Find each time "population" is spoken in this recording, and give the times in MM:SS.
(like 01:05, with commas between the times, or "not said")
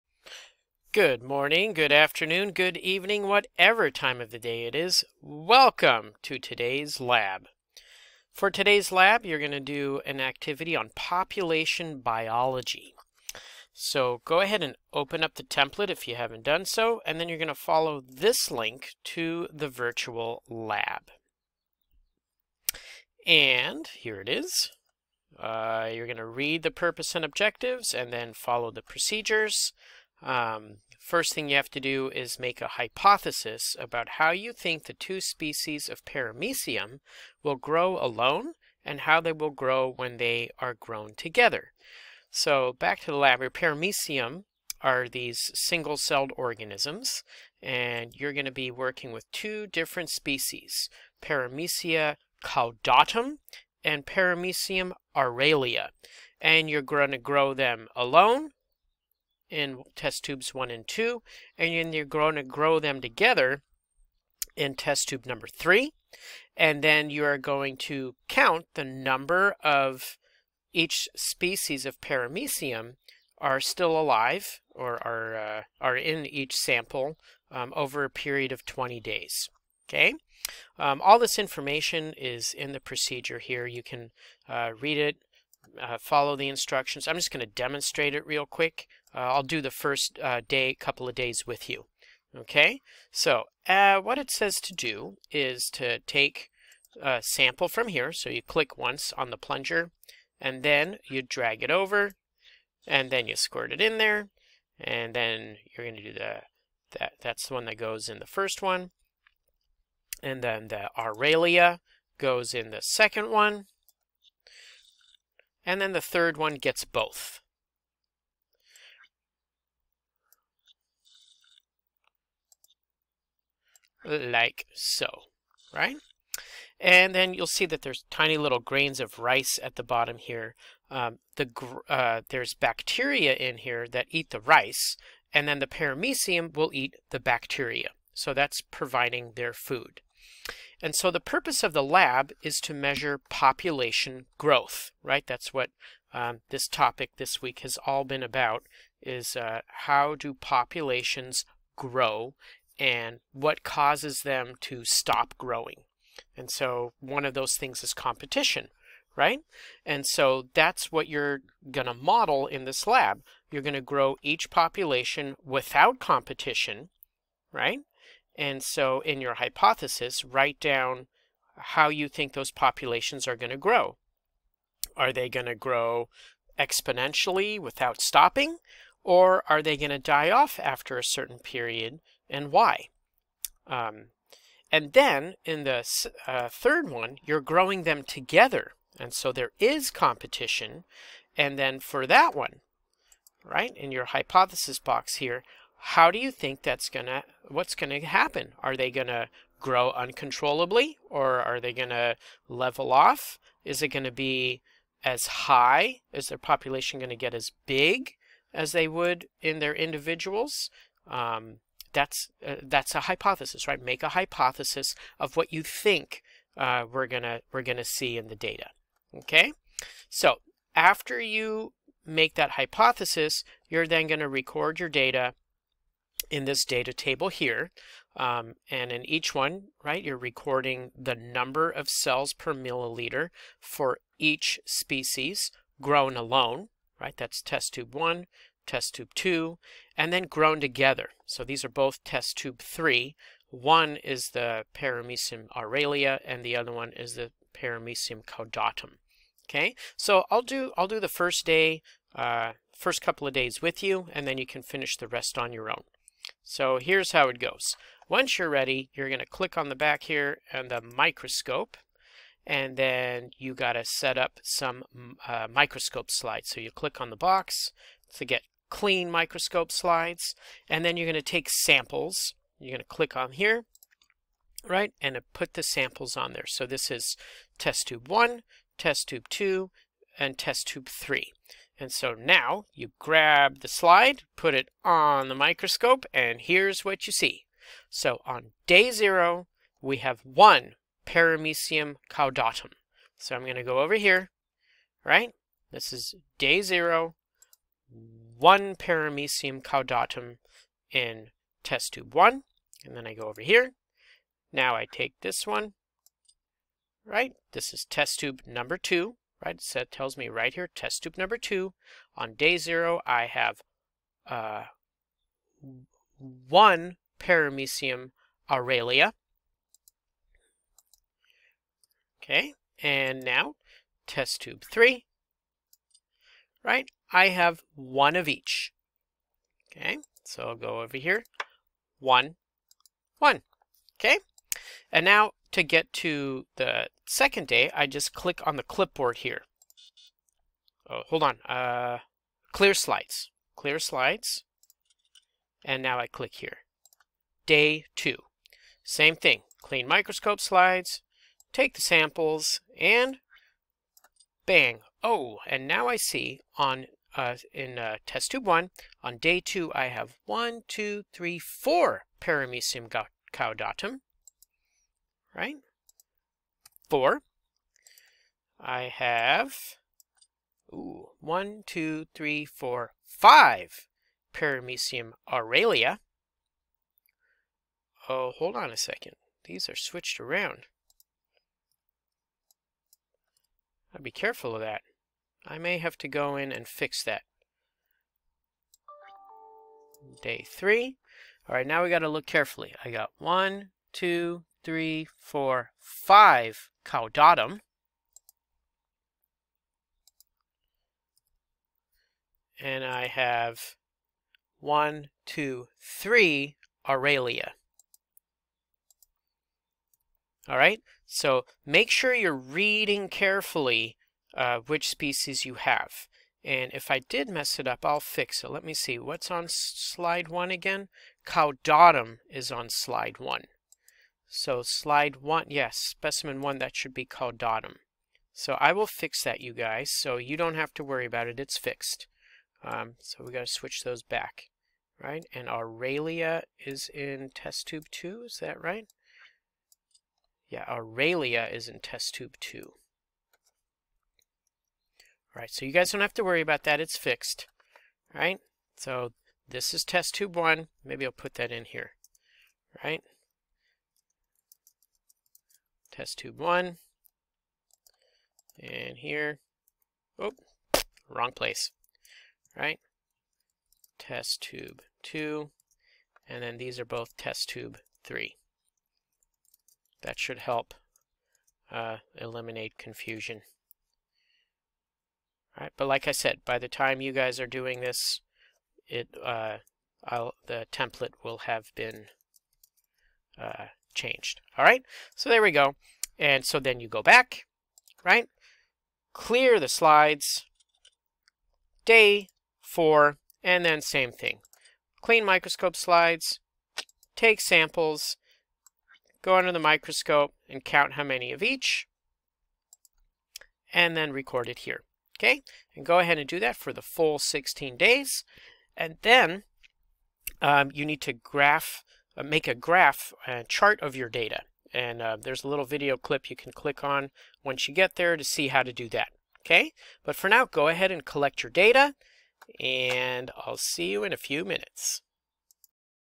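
00:10, 02:23, 02:30, 02:44, 02:52, 03:26.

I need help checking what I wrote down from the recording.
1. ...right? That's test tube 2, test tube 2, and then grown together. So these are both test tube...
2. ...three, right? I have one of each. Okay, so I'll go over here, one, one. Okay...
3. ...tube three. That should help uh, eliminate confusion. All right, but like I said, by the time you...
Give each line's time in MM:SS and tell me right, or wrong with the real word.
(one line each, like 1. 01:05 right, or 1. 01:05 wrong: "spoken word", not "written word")
1. 03:56 wrong: "1", not "2"
2. 05:24 right
3. 07:47 right.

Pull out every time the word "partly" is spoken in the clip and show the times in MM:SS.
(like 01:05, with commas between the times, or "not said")
not said.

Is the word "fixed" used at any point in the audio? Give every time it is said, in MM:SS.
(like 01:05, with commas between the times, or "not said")
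07:11, 07:26.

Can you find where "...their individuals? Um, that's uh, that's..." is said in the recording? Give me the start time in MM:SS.
03:29.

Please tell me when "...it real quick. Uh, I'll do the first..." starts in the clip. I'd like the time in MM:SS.
01:28.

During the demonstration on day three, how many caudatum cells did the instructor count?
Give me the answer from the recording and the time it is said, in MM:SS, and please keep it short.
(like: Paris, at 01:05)
5, at 06:33.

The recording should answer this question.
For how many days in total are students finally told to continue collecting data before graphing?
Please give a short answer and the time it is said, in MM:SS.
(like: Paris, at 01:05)
16, at 08:27.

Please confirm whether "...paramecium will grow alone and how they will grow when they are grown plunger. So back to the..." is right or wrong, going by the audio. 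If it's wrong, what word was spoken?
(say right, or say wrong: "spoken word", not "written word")
wrong: "together", not "plunger".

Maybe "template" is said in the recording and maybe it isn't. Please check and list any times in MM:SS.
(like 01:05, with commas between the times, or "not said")
00:15, 08:00.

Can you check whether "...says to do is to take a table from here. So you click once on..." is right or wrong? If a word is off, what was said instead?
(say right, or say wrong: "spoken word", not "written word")
wrong: "sample", not "table".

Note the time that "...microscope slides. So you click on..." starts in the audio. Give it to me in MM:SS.
04:25.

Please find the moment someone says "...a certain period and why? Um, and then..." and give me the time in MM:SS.
03:00.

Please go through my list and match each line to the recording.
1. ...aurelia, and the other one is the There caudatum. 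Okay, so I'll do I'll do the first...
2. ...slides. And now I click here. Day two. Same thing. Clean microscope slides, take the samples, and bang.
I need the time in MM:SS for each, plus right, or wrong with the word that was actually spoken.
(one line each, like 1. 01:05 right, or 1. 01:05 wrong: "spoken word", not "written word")
1. 04:05 wrong: "Paramecium", not "There"
2. 05:43 right.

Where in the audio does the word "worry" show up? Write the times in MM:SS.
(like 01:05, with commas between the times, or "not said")
07:10, 07:26.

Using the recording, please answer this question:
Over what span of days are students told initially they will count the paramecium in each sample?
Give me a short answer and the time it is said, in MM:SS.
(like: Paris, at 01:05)
20 days, at 01:18.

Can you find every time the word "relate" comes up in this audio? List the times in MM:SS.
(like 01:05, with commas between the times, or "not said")
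not said.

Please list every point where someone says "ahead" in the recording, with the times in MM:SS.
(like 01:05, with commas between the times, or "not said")
00:14, 08:25, 08:40.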